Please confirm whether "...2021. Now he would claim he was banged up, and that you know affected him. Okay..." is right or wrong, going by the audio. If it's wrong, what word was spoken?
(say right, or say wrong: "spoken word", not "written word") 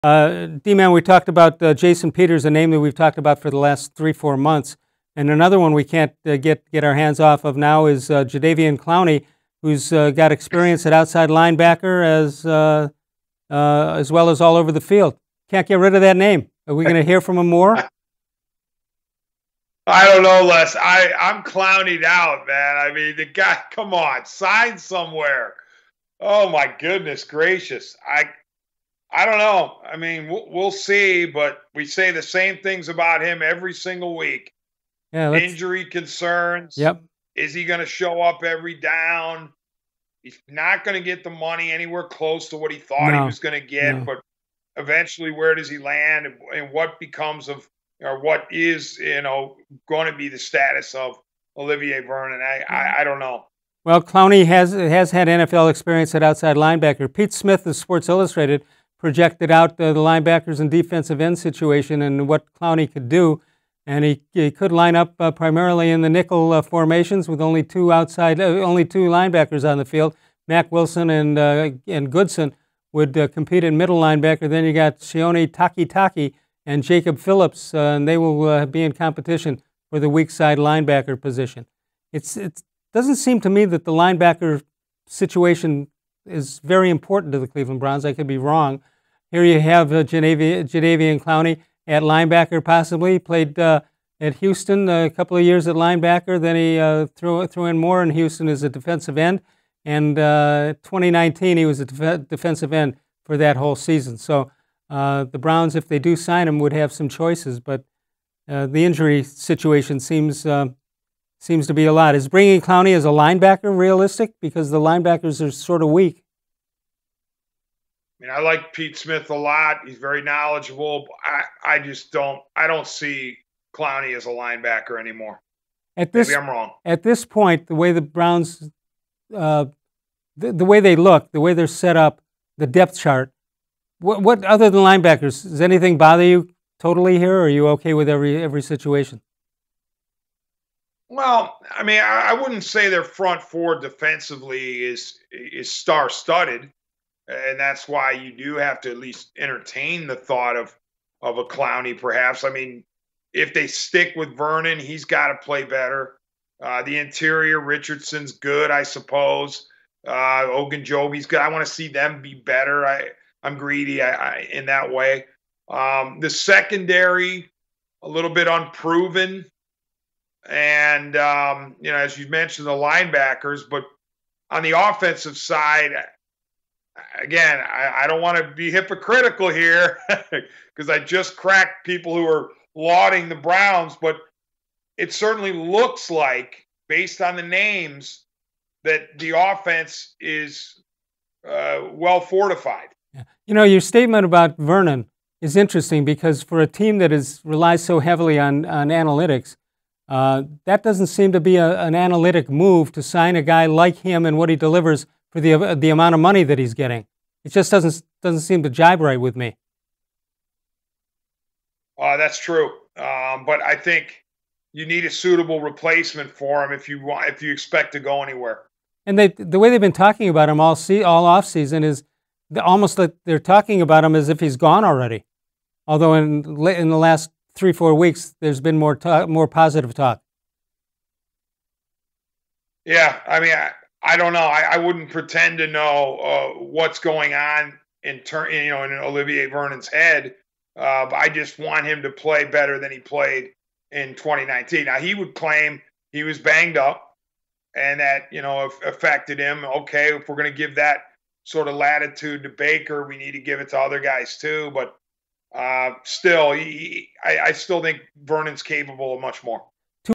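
wrong: "2019", not "2021".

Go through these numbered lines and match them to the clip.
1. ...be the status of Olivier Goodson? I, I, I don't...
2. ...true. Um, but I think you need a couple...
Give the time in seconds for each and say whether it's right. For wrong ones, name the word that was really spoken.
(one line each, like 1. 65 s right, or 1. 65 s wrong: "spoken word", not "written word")
1. 50 s wrong: "Vernon", not "Goodson"
2. 212 s wrong: "suitable", not "couple".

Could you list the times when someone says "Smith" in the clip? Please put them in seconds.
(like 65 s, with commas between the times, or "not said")
57 s, 118 s.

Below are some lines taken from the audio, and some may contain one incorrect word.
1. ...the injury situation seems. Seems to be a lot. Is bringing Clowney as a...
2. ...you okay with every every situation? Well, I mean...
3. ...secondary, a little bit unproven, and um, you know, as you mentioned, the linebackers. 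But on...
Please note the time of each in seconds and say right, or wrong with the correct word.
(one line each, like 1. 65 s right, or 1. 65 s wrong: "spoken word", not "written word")
1. 108 s right
2. 137 s right
3. 166 s right.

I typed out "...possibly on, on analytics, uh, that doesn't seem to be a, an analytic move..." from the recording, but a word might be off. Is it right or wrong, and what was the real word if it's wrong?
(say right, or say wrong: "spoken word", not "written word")
wrong: "heavily", not "possibly".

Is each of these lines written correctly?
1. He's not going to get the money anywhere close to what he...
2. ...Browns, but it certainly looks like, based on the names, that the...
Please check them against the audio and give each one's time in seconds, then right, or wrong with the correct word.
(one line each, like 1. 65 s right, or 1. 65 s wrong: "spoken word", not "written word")
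1. 40 s right
2. 183 s right.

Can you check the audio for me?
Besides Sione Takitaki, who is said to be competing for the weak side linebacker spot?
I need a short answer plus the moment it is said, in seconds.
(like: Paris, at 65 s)
Jacob Phillips, at 76 s.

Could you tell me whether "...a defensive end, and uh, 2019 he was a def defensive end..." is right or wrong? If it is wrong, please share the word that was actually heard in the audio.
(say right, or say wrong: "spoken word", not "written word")
right.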